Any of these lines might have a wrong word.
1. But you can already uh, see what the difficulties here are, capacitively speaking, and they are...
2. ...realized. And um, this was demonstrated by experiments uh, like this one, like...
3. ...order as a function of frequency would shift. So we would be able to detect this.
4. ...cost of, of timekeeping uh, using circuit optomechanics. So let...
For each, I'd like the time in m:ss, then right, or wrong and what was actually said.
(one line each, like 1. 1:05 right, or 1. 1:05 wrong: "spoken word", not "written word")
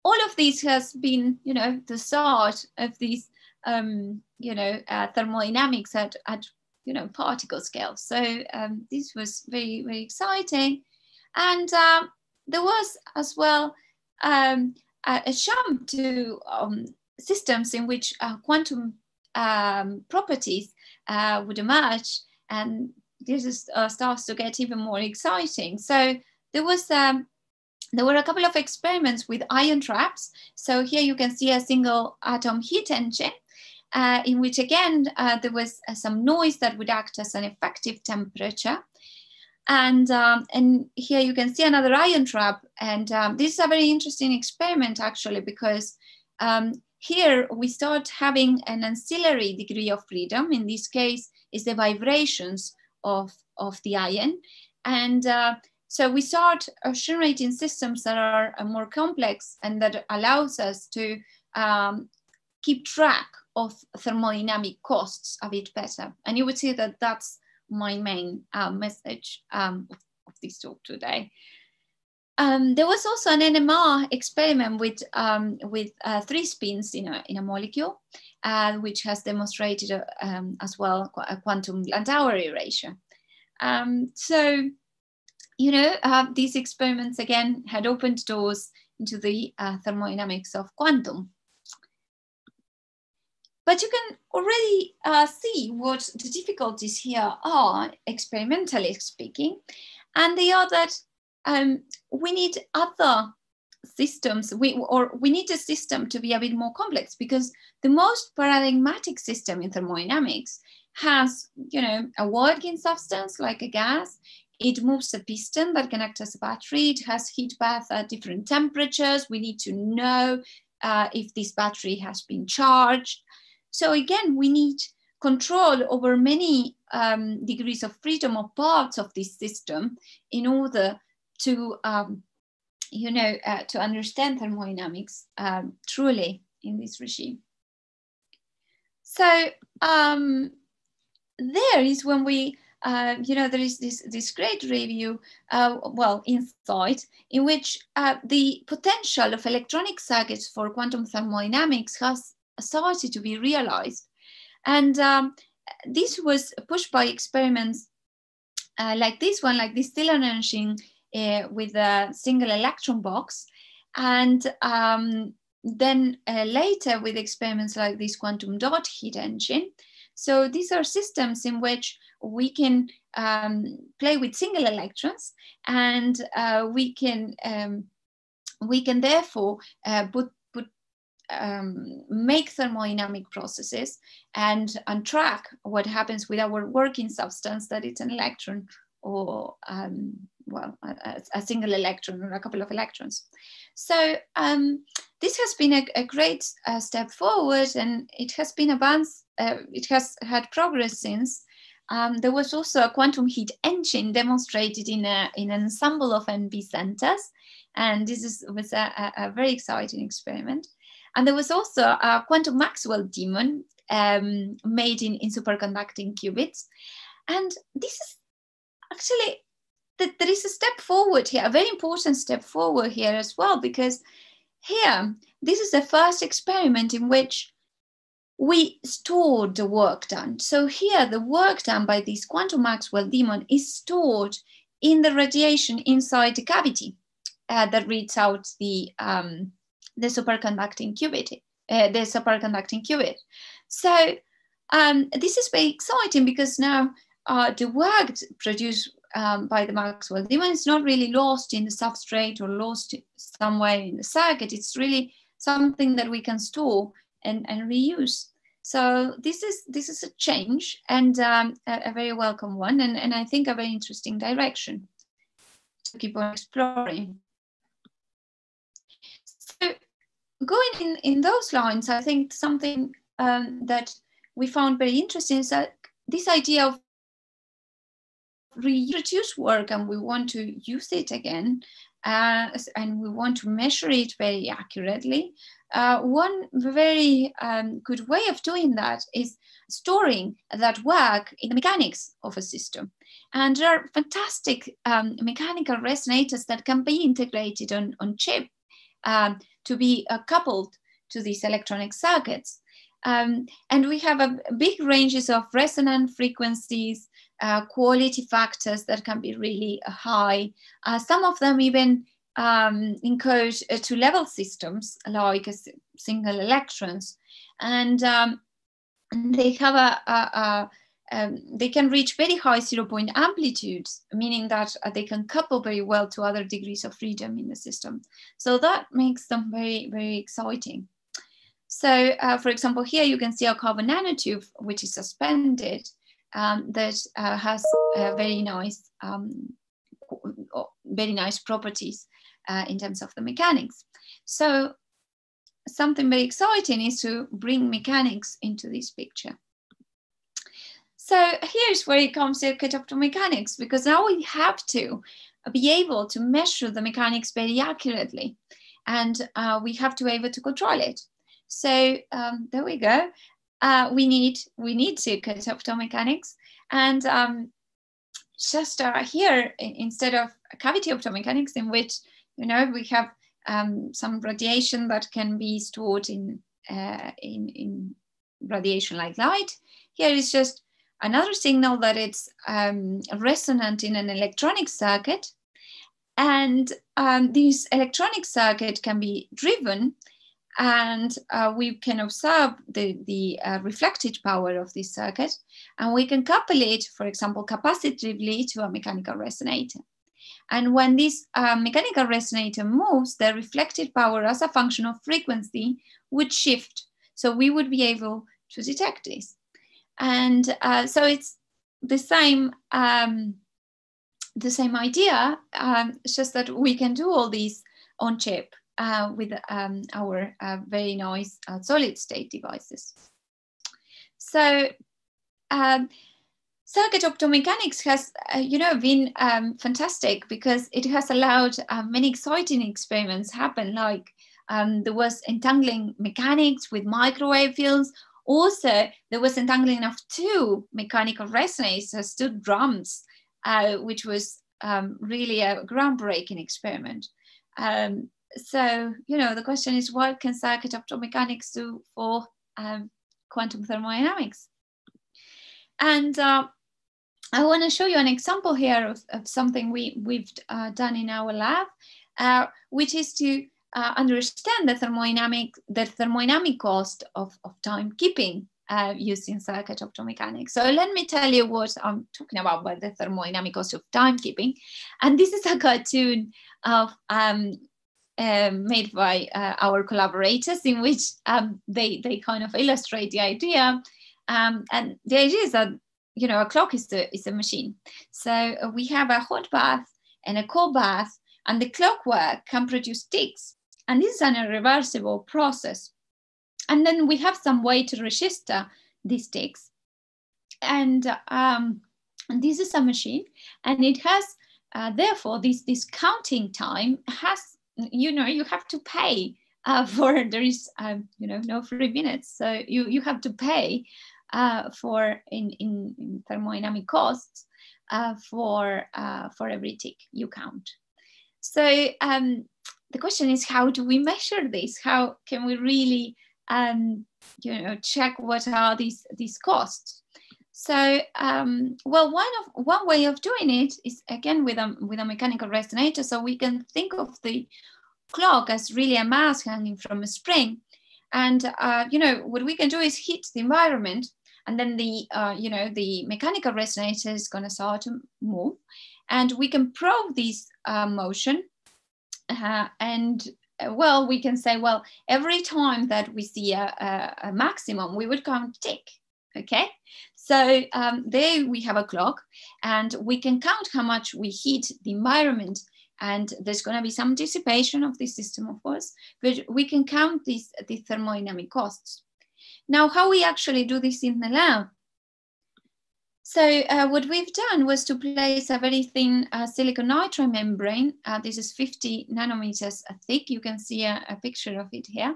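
1. 1:33 wrong: "experimentally", not "capacitively"
2. 2:33 wrong: "pushed", not "demonstrated"
3. 6:43 wrong: "power", not "order"
4. 7:46 right.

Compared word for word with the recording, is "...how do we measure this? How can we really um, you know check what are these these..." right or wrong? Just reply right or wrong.
right.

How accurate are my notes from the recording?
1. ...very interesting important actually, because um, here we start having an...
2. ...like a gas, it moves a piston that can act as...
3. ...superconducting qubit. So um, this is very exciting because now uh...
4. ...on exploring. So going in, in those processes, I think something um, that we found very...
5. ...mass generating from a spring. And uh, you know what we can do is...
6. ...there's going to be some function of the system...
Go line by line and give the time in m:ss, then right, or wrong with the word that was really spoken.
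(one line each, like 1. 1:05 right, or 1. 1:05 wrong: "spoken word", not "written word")
1. 0:43 wrong: "experiment", not "important"
2. 1:53 right
3. 4:01 right
4. 4:26 wrong: "lines", not "processes"
5. 8:59 wrong: "hanging", not "generating"
6. 9:26 wrong: "dissipation", not "function".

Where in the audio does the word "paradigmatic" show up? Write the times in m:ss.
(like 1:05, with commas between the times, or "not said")
1:48.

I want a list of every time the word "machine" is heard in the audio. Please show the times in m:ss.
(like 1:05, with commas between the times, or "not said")
8:07, 8:22.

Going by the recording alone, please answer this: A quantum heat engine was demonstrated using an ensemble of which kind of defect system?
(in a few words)
NV centers.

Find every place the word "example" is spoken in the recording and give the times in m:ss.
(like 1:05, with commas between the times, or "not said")
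5:32, 6:37, 7:38.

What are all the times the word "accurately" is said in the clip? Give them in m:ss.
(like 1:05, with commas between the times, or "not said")
4:44, 5:57.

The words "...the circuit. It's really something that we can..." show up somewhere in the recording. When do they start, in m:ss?
4:13.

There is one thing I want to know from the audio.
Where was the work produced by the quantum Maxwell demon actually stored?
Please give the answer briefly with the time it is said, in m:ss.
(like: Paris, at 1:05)
Radiation inside the cavity, at 3:55.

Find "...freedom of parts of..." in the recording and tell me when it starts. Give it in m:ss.
2:08.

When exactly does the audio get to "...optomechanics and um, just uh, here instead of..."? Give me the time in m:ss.
6:05.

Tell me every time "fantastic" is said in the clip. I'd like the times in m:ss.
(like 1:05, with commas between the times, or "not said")
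4:53, 7:09.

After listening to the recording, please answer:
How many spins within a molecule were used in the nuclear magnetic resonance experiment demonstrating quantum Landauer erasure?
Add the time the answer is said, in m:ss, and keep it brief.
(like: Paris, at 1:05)
3, at 1:16.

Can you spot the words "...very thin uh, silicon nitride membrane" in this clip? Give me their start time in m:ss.
9:38.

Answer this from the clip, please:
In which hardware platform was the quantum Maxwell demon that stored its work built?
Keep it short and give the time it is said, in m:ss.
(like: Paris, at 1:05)
Superconducting qubits, at 3:35.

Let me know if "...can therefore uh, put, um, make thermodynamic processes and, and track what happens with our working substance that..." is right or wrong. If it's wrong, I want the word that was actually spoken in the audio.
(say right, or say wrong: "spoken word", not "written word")
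right.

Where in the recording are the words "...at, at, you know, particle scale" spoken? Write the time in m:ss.
0:05.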